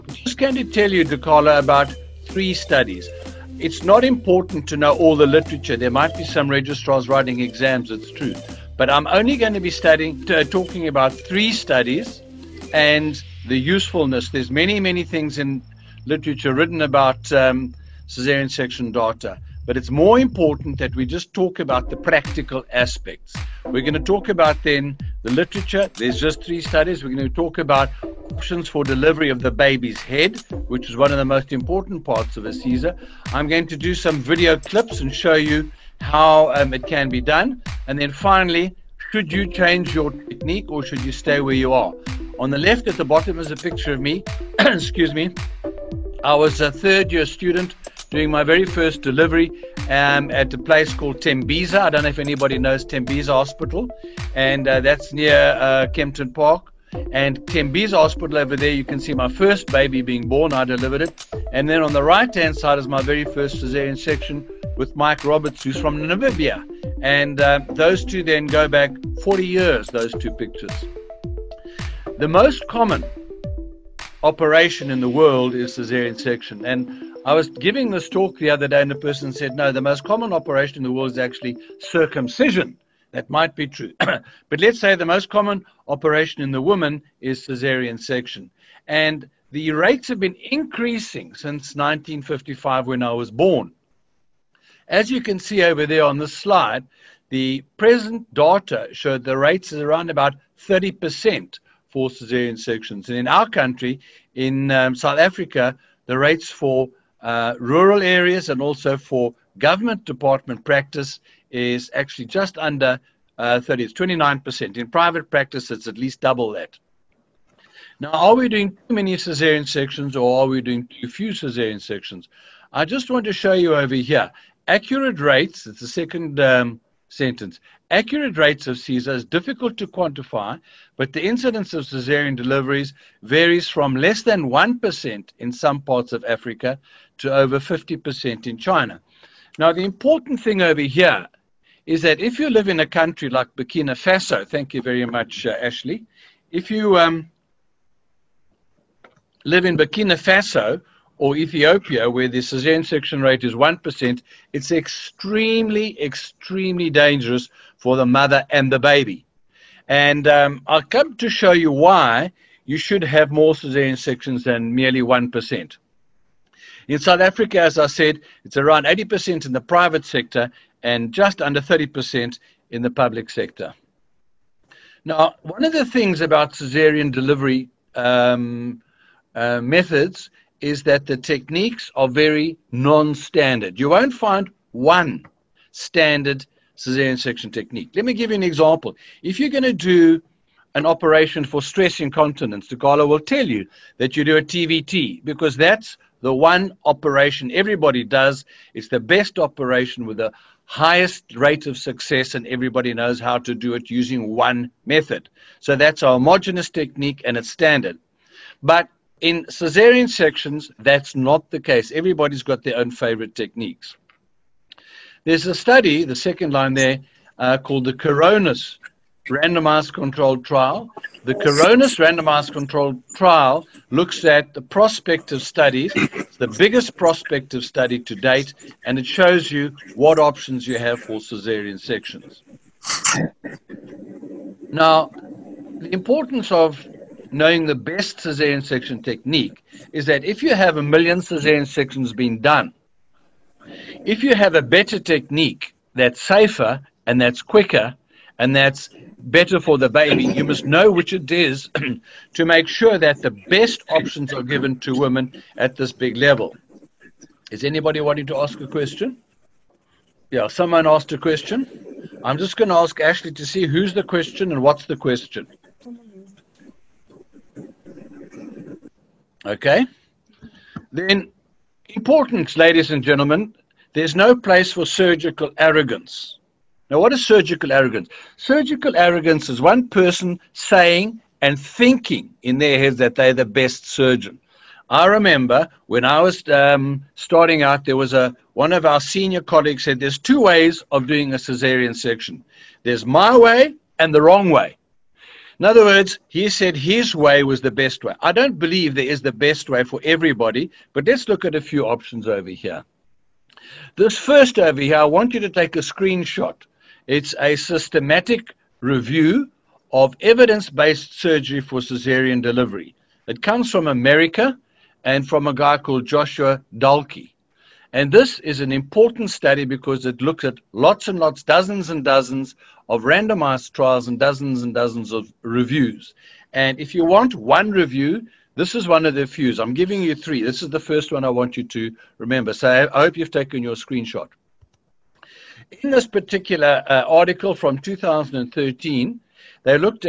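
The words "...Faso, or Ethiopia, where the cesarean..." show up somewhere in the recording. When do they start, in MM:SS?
02:30.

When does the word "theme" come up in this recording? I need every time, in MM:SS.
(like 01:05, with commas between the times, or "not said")
not said.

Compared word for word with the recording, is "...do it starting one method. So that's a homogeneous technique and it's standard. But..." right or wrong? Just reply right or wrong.
wrong.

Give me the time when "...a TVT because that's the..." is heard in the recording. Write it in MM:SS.
03:14.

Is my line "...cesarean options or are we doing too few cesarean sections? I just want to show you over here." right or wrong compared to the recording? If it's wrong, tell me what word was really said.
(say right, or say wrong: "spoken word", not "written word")
wrong: "sections", not "options".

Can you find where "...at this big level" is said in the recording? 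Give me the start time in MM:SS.
04:15.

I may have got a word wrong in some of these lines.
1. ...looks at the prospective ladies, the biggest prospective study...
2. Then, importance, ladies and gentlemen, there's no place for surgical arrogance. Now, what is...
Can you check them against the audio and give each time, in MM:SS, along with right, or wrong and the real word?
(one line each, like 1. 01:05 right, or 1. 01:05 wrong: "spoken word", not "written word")
1. 03:43 wrong: "studies", not "ladies"
2. 04:30 right.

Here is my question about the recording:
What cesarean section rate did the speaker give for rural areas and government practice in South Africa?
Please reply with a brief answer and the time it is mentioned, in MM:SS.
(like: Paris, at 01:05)
29%, at 01:53.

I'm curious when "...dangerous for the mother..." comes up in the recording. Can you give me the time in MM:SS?
02:36.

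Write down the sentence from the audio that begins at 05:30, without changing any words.
This is the first one I want you to remember.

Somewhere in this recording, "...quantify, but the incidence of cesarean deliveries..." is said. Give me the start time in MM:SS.
02:09.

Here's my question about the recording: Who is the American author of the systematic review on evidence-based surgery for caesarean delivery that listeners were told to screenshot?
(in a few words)
Joshua Dahlke.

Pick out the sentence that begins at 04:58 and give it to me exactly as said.
I don't believe there is the best way for everybody, but let's look at a few options over here.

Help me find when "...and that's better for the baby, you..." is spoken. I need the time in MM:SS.
04:08.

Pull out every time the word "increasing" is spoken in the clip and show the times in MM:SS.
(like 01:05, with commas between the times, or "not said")
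01:30.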